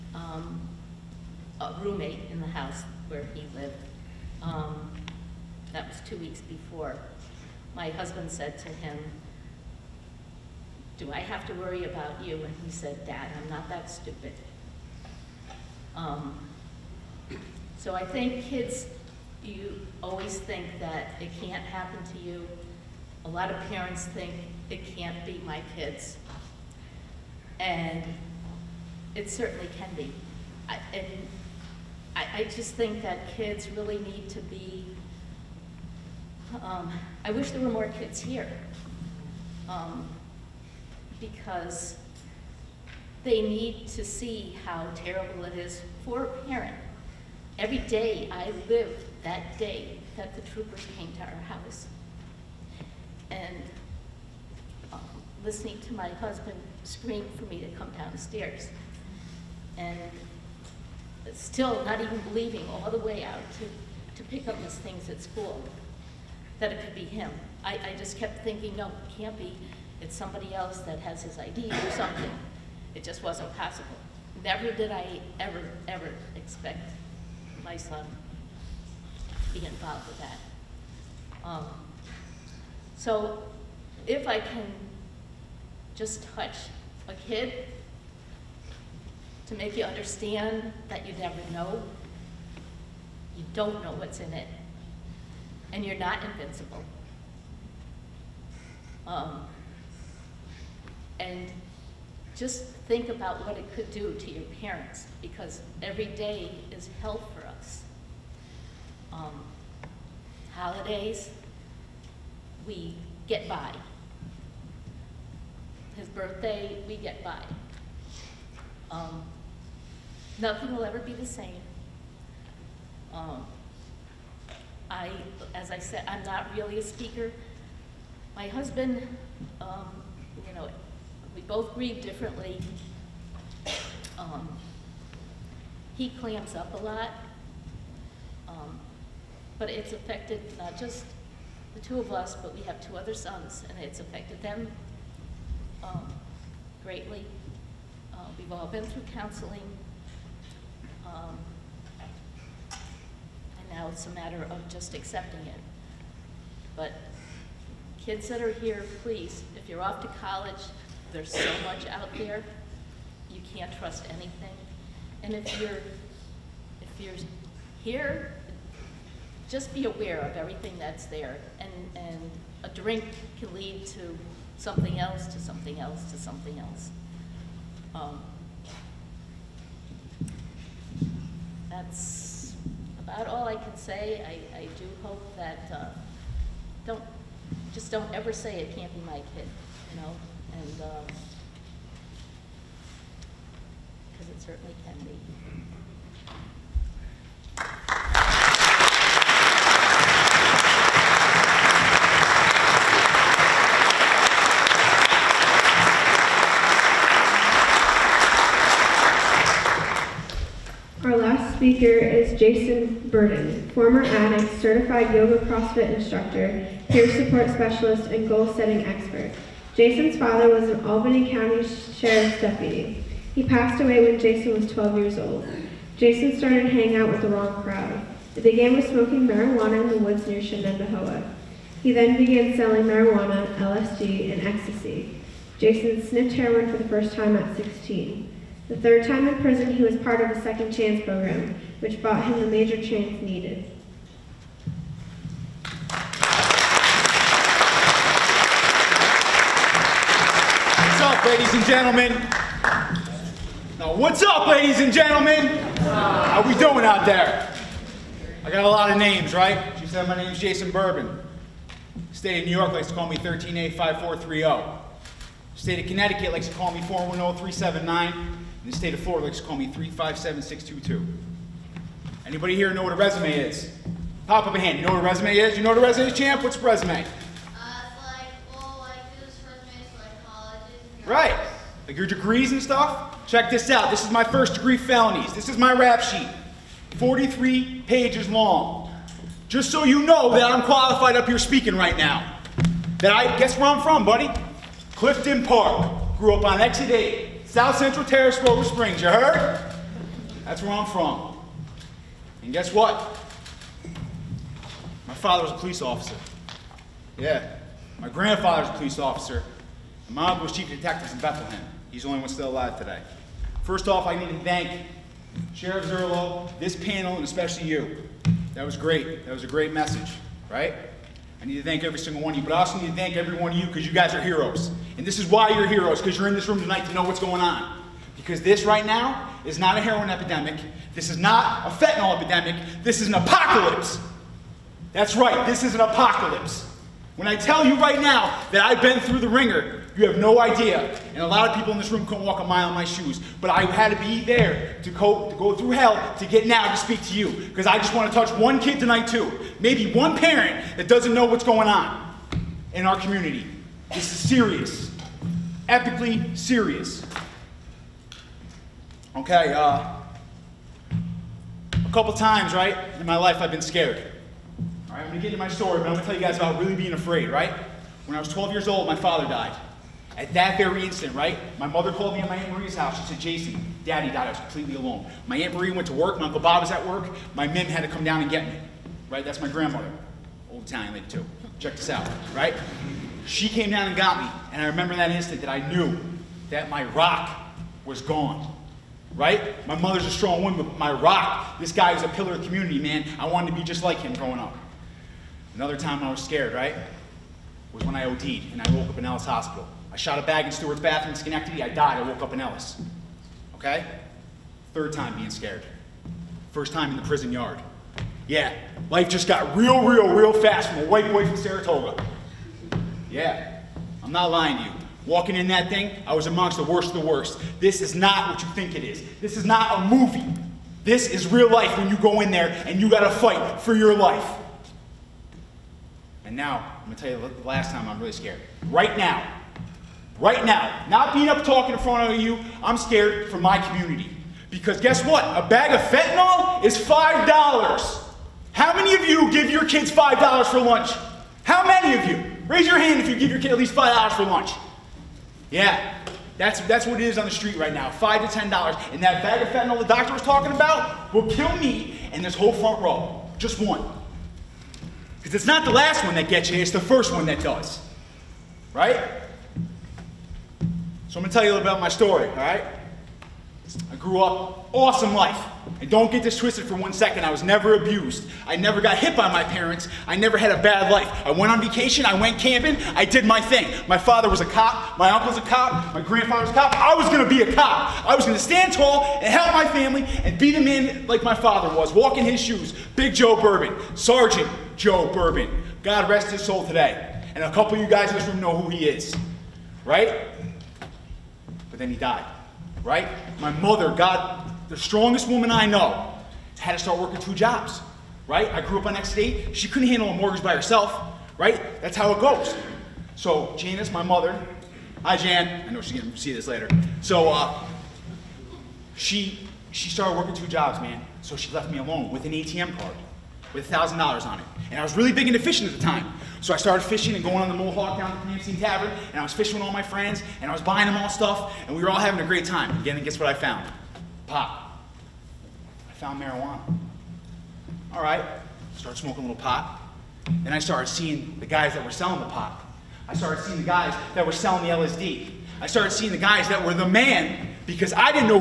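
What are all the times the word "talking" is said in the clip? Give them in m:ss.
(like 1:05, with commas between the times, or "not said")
7:11, 7:30.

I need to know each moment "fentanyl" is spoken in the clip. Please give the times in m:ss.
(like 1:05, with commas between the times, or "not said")
5:31, 7:15, 7:29.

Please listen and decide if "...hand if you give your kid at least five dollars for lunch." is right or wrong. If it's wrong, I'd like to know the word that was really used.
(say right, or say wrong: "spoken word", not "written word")
right.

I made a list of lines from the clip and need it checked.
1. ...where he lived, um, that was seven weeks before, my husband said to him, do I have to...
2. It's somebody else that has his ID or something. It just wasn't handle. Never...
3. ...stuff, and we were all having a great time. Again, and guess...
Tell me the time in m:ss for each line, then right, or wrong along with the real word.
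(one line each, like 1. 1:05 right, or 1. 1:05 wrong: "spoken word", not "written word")
1. 0:03 wrong: "two", not "seven"
2. 1:10 wrong: "possible", not "handle"
3. 8:41 right.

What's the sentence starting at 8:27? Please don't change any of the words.
So uh, she she started working two jobs, man.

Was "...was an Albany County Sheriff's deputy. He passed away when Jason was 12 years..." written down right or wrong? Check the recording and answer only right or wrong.
right.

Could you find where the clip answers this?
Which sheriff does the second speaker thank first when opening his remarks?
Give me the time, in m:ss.
5:15.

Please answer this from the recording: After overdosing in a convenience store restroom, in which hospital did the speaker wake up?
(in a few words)
Ellis Hospital.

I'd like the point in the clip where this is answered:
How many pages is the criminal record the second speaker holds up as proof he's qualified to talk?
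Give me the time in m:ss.
4:46.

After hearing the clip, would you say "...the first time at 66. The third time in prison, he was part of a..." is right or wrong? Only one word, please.
wrong.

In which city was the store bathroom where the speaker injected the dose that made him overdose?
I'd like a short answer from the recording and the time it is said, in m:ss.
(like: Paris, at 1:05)
Schenectady, at 6:41.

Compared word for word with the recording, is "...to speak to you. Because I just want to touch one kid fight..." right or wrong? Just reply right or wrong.
wrong.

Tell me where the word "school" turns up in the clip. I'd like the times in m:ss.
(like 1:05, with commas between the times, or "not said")
1:05.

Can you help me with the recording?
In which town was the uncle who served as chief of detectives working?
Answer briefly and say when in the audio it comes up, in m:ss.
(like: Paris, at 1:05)
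Bethlehem, at 5:11.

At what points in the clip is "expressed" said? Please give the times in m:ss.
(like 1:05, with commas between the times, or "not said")
not said.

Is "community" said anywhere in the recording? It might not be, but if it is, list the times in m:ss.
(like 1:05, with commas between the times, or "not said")
5:52, 6:32, 7:13.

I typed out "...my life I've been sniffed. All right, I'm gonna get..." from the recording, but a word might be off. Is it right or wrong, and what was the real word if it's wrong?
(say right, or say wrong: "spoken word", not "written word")
wrong: "scared", not "sniffed".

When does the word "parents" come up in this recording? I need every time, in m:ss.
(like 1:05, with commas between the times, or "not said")
0:23, 0:46, 1:44, 5:50, 7:49.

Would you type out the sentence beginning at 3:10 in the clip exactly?
And, because um, it certainly can be.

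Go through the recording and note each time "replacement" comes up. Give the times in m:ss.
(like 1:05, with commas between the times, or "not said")
not said.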